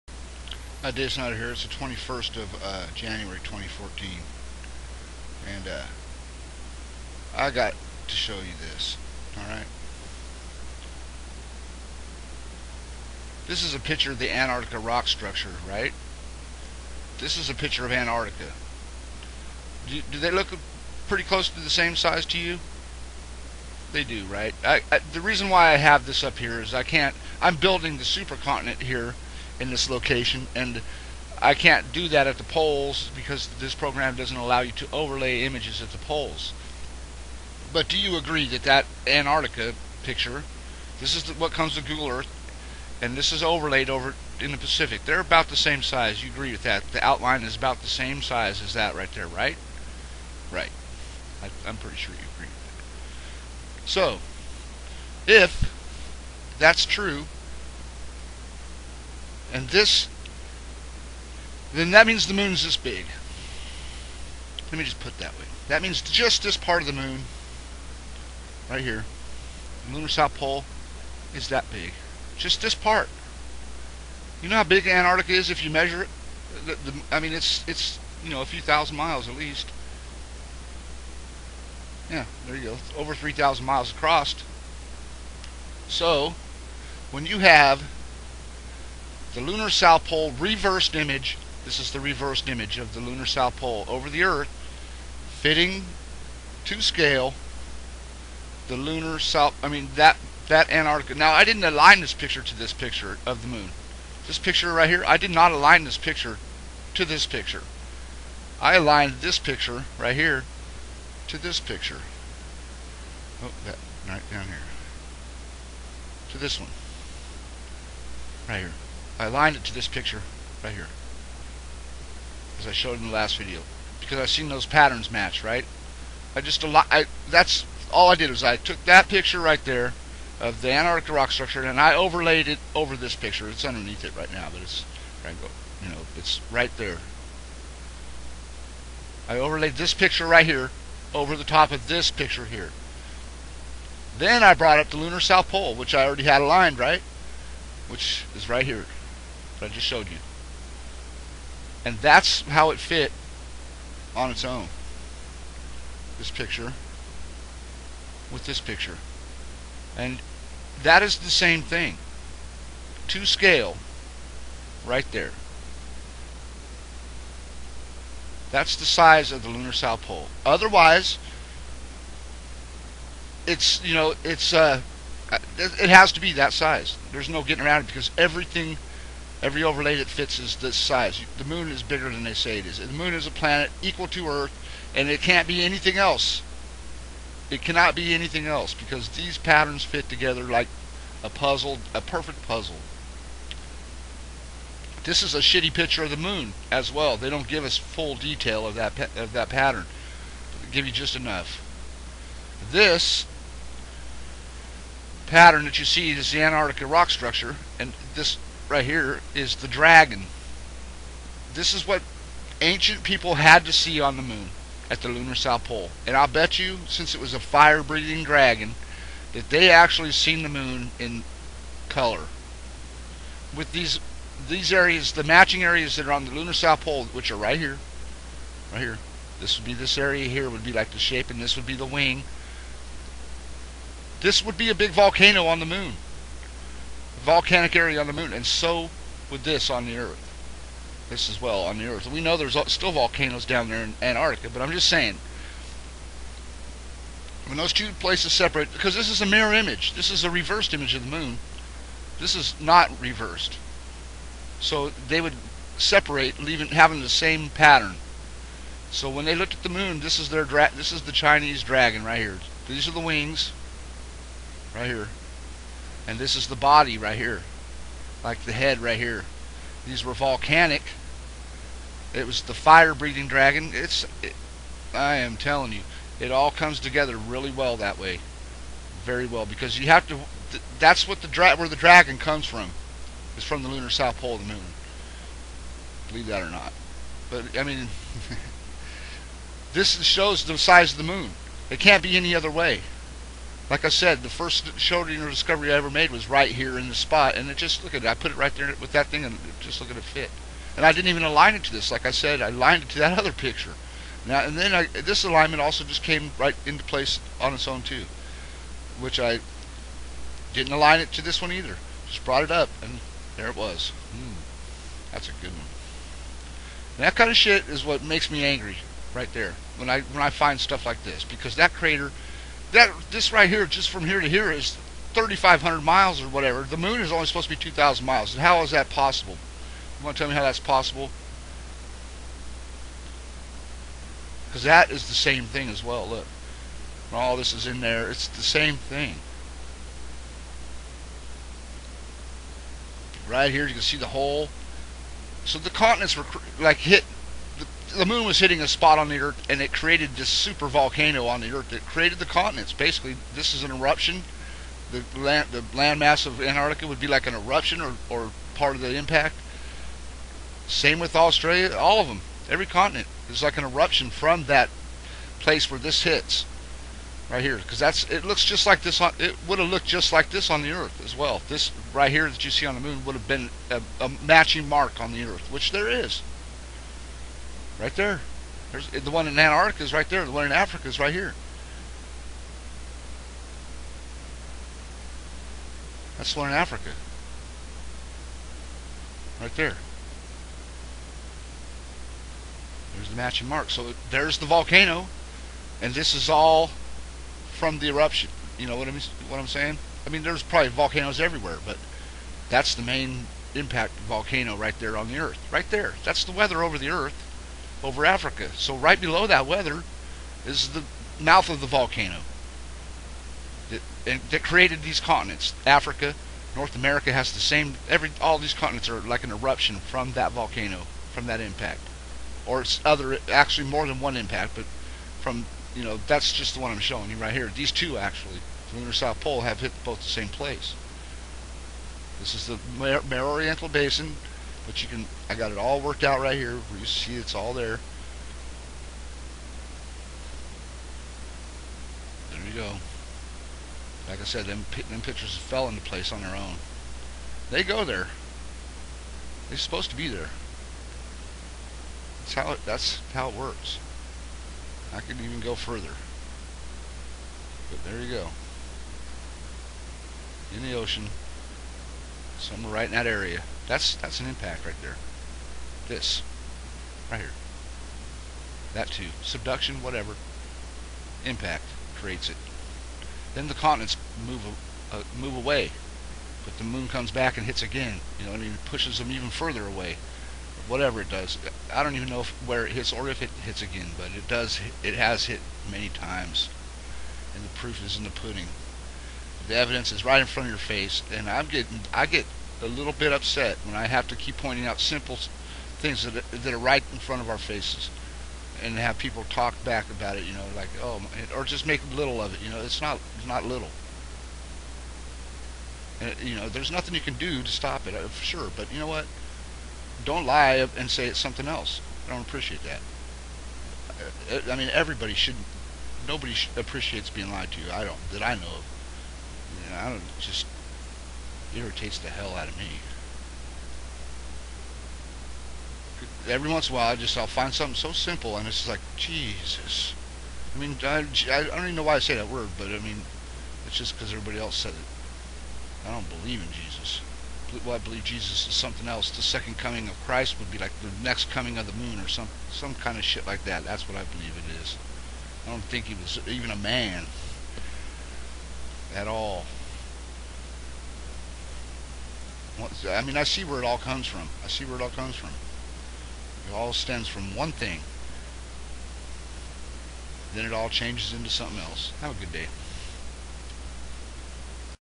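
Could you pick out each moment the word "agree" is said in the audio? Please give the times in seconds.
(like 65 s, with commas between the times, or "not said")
38 s, 46 s, 52 s.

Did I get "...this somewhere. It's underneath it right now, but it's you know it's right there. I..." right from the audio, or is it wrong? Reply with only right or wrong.
wrong.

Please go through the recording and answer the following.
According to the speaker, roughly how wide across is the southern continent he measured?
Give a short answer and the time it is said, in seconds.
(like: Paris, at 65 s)
over 3,000 miles, at 82 s.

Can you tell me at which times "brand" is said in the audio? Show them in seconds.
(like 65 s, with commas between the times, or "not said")
not said.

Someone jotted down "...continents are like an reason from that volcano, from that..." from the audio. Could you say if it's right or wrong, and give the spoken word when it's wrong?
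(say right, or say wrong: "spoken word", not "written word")
wrong: "eruption", not "reason".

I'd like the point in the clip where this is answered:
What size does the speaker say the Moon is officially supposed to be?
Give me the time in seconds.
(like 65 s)
327 s.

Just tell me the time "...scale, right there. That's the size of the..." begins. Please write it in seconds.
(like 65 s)
163 s.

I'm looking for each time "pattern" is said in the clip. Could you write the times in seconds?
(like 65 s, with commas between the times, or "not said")
124 s, 189 s, 199 s, 205 s, 257 s.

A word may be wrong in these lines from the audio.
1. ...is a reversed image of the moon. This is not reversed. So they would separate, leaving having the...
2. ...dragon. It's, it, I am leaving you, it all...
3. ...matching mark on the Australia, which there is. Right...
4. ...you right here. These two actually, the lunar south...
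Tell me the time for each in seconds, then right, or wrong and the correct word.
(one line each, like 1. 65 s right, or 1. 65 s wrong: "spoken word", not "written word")
1. 250 s right
2. 273 s wrong: "telling", not "leaving"
3. 374 s wrong: "Earth", not "Australia"
4. 427 s right.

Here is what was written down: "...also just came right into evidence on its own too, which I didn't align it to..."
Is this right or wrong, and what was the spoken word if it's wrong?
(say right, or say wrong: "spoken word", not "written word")
wrong: "place", not "evidence".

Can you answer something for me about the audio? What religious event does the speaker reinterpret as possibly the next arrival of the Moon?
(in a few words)
second coming of Christ.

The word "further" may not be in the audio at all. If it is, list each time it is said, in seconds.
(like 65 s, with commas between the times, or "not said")
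455 s, 479 s.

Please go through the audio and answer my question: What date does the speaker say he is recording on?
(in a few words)
21st of January 2014.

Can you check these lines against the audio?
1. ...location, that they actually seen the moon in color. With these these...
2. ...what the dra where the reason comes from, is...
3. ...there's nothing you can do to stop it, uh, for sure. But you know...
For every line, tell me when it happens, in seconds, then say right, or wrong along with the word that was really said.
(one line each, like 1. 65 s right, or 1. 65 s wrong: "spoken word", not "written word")
1. 218 s wrong: "dragon", not "location"
2. 281 s wrong: "dragon", not "reason"
3. 506 s right.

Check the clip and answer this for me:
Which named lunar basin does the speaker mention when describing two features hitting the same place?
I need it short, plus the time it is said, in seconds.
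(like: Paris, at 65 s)
Mare Orientale Basin, at 432 s.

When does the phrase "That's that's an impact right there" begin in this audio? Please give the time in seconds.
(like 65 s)
463 s.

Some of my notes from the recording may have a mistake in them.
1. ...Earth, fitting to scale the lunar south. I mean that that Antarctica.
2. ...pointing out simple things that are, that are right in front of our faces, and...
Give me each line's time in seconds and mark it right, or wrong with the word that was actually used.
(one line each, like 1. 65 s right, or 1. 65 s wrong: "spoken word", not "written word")
1. 94 s right
2. 494 s right.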